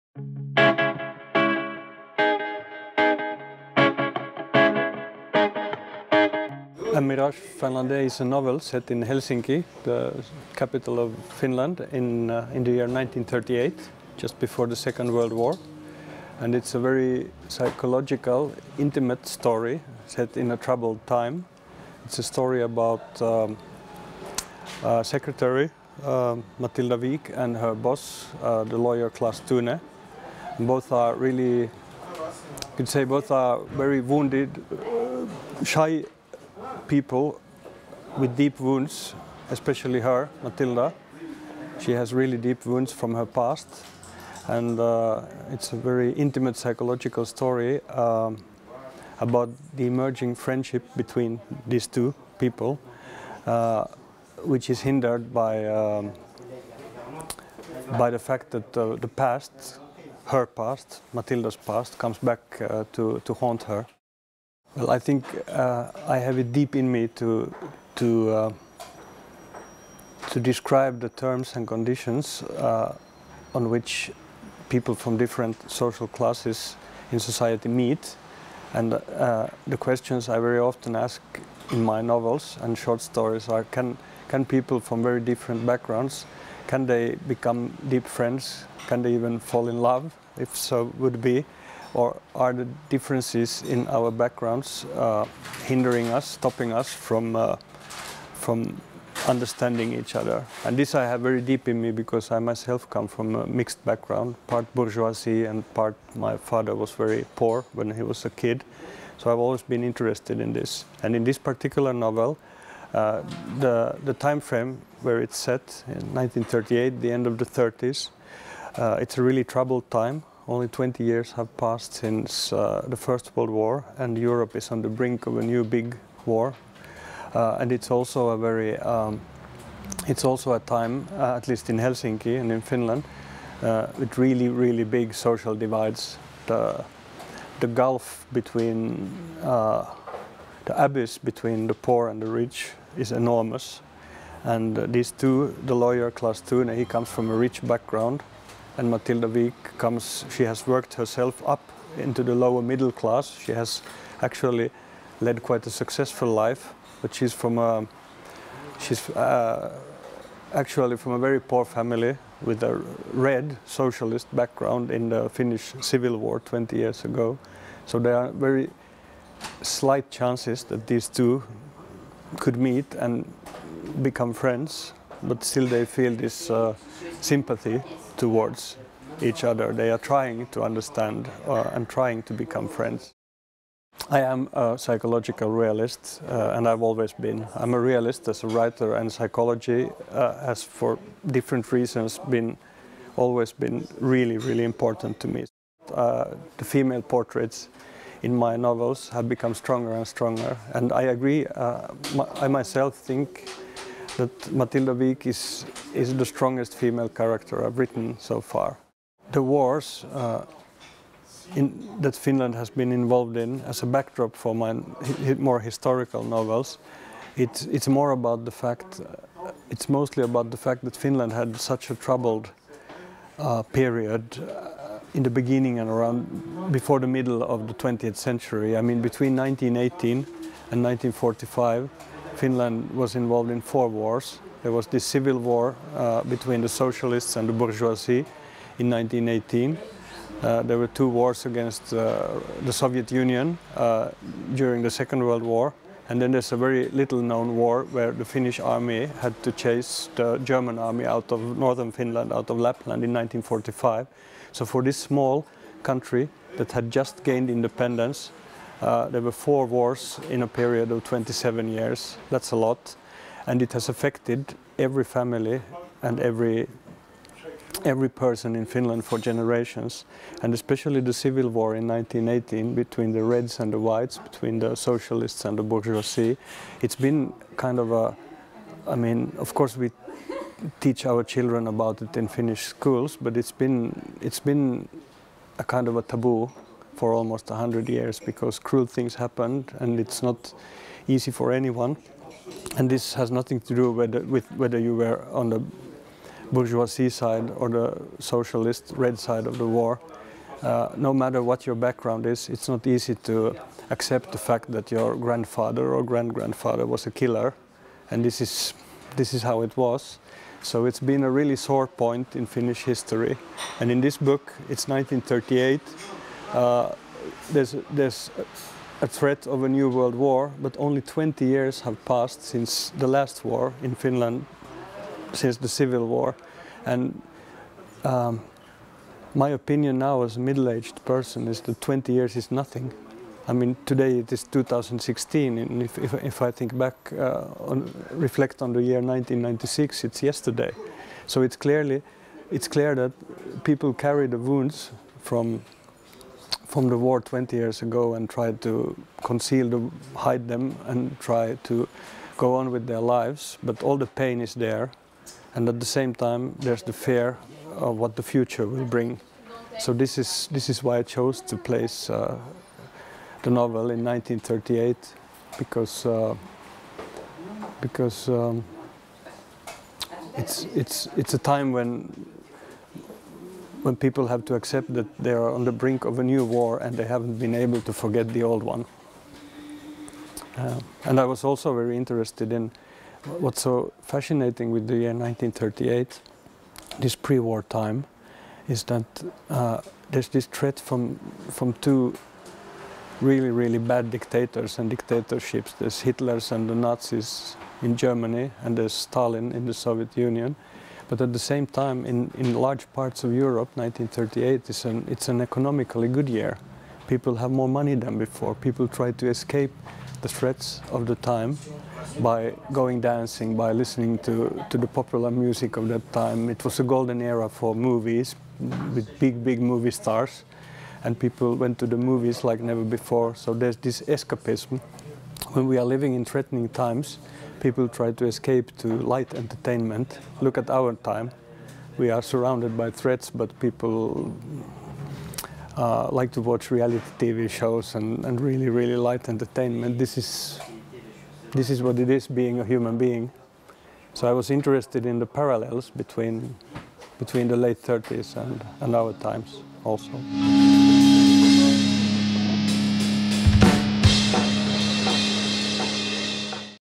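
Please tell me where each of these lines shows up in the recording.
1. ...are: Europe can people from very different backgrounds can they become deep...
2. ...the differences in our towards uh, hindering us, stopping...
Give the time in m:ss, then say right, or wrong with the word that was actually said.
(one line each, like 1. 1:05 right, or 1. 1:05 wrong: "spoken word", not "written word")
1. 1:23 wrong: "Can", not "Europe"
2. 1:32 wrong: "backgrounds", not "towards".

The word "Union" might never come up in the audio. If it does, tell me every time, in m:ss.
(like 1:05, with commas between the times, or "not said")
4:03, 6:40.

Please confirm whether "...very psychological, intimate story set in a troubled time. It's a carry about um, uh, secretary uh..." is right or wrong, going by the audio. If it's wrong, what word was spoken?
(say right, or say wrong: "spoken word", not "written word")
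wrong: "story", not "carry".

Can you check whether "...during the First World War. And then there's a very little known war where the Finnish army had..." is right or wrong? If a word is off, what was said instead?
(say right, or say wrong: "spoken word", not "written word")
wrong: "Second", not "First".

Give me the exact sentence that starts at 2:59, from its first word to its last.
They are trying to understand uh, and trying to become friends.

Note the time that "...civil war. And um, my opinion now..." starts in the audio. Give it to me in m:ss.
5:25.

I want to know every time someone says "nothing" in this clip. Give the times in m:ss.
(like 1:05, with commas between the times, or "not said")
4:53, 5:32.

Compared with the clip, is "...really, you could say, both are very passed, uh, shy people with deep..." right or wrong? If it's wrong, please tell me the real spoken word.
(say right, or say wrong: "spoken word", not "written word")
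wrong: "wounded", not "passed".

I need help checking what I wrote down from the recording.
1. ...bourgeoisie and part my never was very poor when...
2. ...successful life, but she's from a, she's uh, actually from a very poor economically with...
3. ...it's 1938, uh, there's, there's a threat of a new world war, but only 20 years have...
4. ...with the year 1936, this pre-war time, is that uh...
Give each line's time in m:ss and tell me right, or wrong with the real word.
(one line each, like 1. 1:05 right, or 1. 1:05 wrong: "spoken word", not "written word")
1. 1:44 wrong: "father", not "never"
2. 2:35 wrong: "family", not "economically"
3. 5:14 right
4. 6:24 wrong: "1938", not "1936".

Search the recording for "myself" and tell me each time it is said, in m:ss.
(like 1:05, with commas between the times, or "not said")
1:42, 3:22.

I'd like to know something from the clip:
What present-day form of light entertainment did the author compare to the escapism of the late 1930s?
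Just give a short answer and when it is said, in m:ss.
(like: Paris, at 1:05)
reality TV shows, at 7:16.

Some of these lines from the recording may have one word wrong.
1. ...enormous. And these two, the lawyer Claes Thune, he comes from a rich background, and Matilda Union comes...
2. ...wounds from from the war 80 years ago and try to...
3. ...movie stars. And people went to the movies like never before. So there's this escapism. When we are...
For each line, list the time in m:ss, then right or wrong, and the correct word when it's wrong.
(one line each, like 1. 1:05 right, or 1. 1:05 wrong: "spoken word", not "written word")
1. 2:23 wrong: "Wiik", not "Union"
2. 5:44 wrong: "20", not "80"
3. 6:59 right.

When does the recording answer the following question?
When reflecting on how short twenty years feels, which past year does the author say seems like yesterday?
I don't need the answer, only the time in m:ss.
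5:38.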